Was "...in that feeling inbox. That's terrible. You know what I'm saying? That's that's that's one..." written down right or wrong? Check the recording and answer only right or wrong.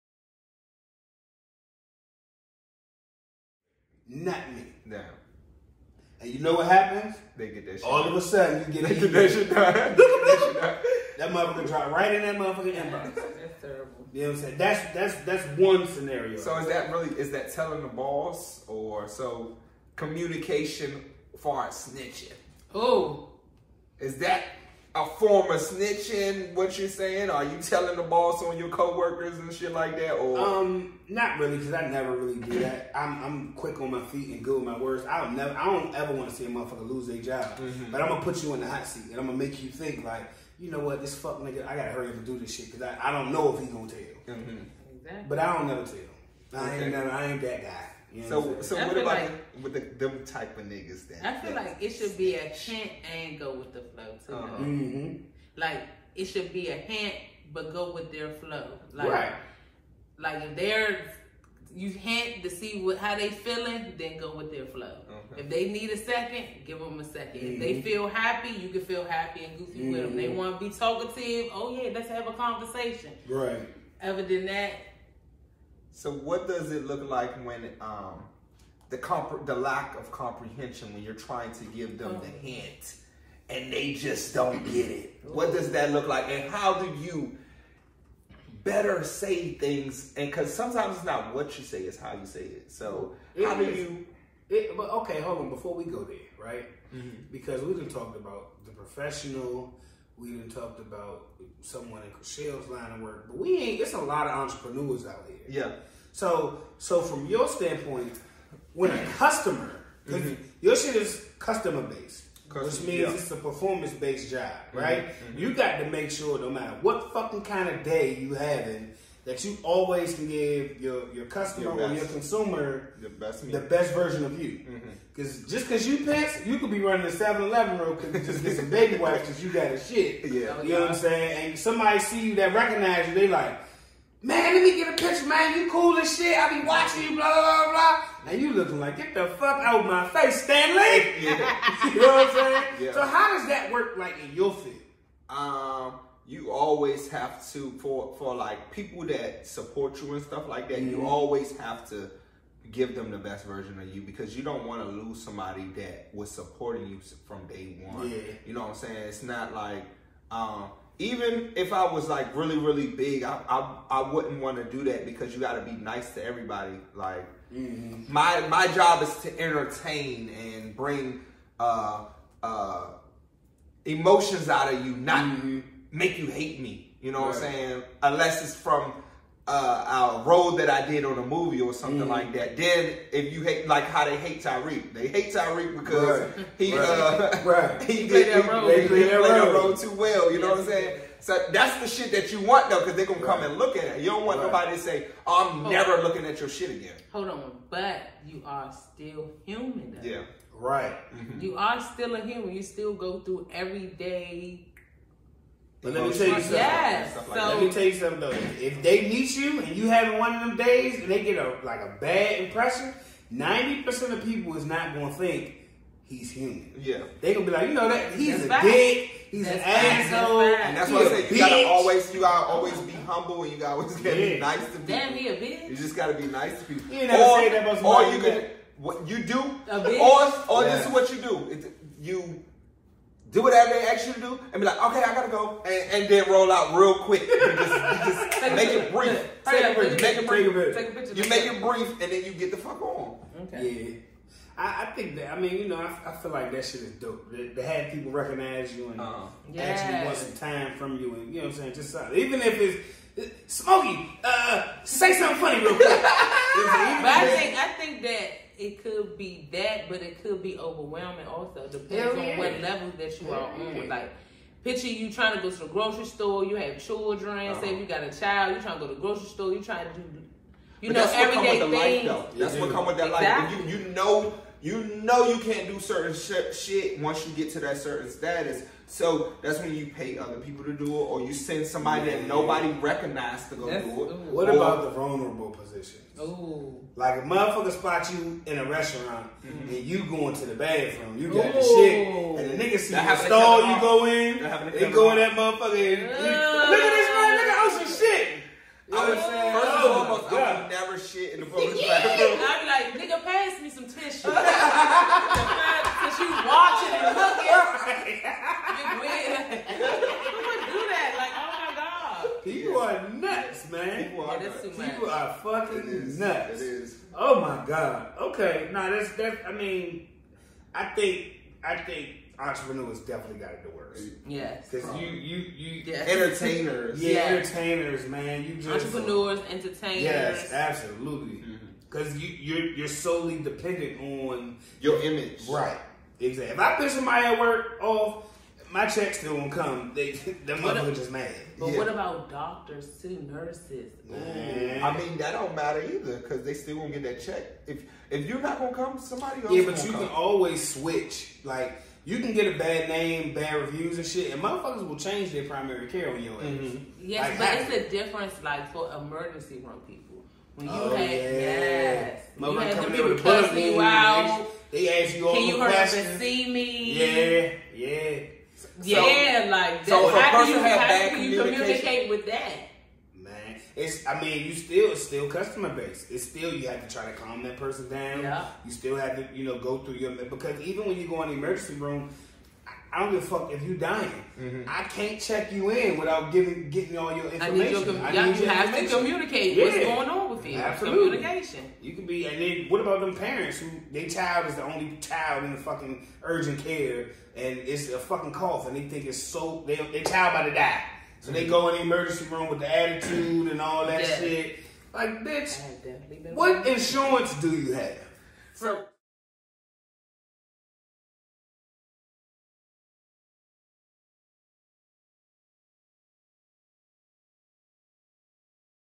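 wrong.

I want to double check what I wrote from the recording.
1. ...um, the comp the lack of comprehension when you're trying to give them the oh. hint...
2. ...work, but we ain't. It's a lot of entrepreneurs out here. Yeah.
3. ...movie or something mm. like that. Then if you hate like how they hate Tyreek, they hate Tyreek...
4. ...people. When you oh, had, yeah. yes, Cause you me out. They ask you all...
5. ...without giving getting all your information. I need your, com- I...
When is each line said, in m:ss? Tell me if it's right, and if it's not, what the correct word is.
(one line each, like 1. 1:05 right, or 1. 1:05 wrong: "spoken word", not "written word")
1. 1:17 right
2. 1:43 right
3. 3:01 right
4. 5:59 wrong: "Mother", not "Cause"
5. 6:25 right.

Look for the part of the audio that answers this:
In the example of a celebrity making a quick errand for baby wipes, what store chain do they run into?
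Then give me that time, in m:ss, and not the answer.
2:07.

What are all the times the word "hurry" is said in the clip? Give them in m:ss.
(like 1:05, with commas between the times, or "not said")
0:41, 6:05.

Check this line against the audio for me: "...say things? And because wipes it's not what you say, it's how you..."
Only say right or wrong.
wrong.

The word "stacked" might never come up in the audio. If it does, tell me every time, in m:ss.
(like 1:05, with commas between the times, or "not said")
not said.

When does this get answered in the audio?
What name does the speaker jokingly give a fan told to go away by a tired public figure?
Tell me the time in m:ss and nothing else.
2:20.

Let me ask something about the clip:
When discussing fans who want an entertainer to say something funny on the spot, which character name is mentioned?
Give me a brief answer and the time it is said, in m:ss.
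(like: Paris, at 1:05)
Smokey, at 4:13.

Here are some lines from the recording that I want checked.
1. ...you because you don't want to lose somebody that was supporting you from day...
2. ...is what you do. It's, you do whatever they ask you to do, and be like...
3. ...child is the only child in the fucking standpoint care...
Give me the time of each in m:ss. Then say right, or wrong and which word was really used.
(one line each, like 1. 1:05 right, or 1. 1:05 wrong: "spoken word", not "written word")
1. 2:33 right
2. 3:50 right
3. 6:34 wrong: "urgent", not "standpoint".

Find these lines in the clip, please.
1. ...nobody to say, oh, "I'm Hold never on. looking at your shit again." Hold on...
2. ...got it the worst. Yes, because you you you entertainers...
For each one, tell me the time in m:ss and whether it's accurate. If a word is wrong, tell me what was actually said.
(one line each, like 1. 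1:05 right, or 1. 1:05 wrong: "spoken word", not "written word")
1. 3:14 right
2. 5:23 right.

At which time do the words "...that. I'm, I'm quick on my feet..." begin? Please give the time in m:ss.
0:32.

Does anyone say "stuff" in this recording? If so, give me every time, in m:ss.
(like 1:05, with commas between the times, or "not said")
2:30.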